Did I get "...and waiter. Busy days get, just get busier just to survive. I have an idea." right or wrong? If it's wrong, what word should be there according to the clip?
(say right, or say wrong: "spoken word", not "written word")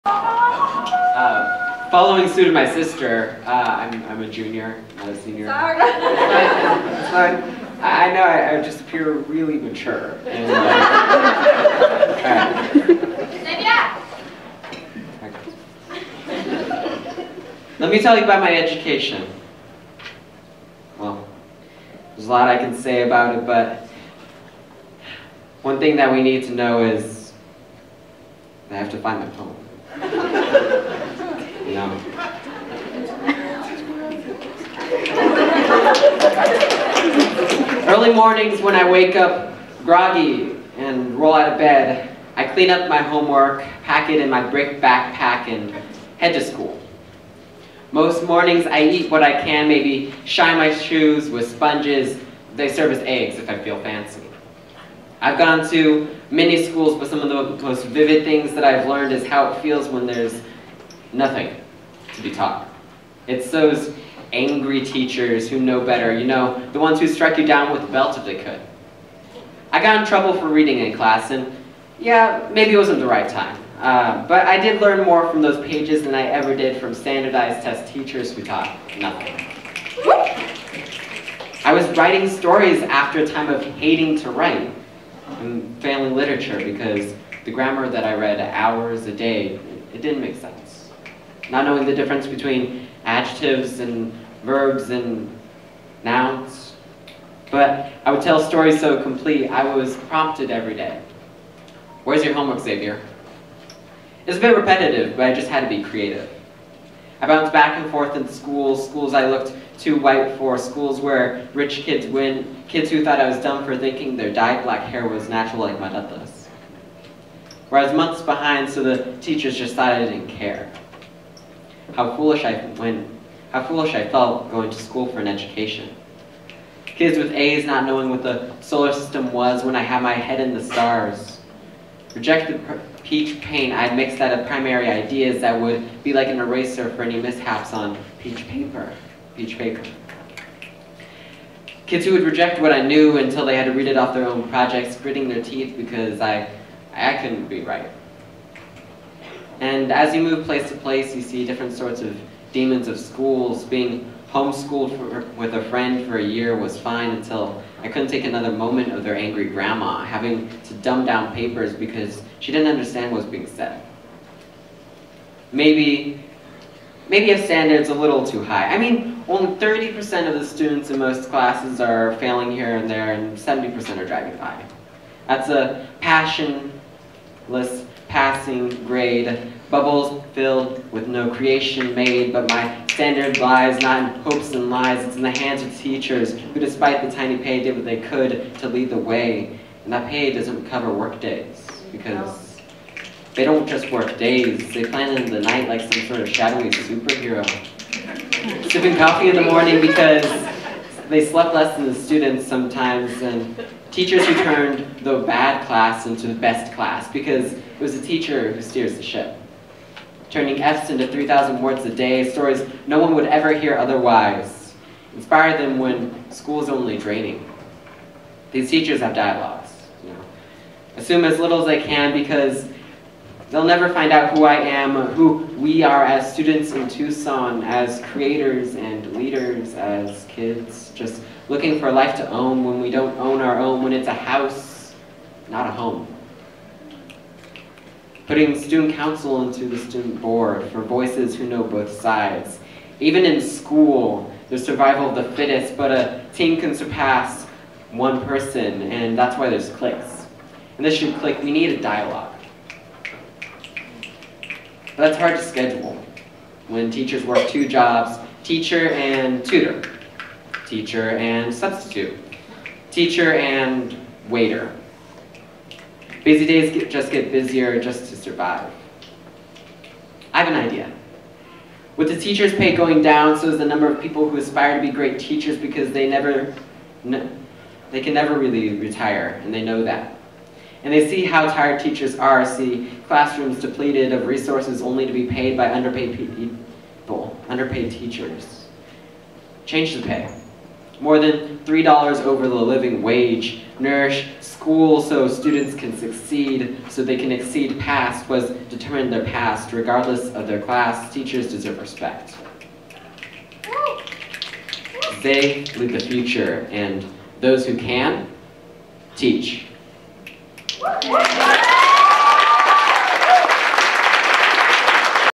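right.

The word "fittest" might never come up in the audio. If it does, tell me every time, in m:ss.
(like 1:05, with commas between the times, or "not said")
4:05.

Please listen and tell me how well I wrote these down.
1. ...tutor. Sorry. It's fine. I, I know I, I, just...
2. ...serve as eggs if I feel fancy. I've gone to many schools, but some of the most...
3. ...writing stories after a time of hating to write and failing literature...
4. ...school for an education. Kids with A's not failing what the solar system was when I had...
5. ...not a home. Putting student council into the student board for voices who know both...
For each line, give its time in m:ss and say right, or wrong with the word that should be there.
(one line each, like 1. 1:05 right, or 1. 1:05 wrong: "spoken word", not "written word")
1. 0:05 wrong: "senior", not "tutor"
2. 0:52 right
3. 1:21 right
4. 2:04 wrong: "knowing", not "failing"
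5. 3:55 right.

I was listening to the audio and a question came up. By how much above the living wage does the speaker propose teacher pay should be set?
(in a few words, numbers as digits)
More than $3.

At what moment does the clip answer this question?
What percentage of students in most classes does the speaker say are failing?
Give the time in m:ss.
2:49.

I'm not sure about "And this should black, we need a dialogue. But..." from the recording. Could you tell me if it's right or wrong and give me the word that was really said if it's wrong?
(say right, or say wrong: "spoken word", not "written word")
wrong: "click", not "black".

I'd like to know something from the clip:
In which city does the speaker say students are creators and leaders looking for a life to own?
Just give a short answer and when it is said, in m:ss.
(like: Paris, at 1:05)
Tucson, at 3:46.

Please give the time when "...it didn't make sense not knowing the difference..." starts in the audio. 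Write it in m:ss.
1:29.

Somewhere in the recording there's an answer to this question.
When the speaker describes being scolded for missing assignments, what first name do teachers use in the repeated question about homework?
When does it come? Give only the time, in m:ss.
1:42.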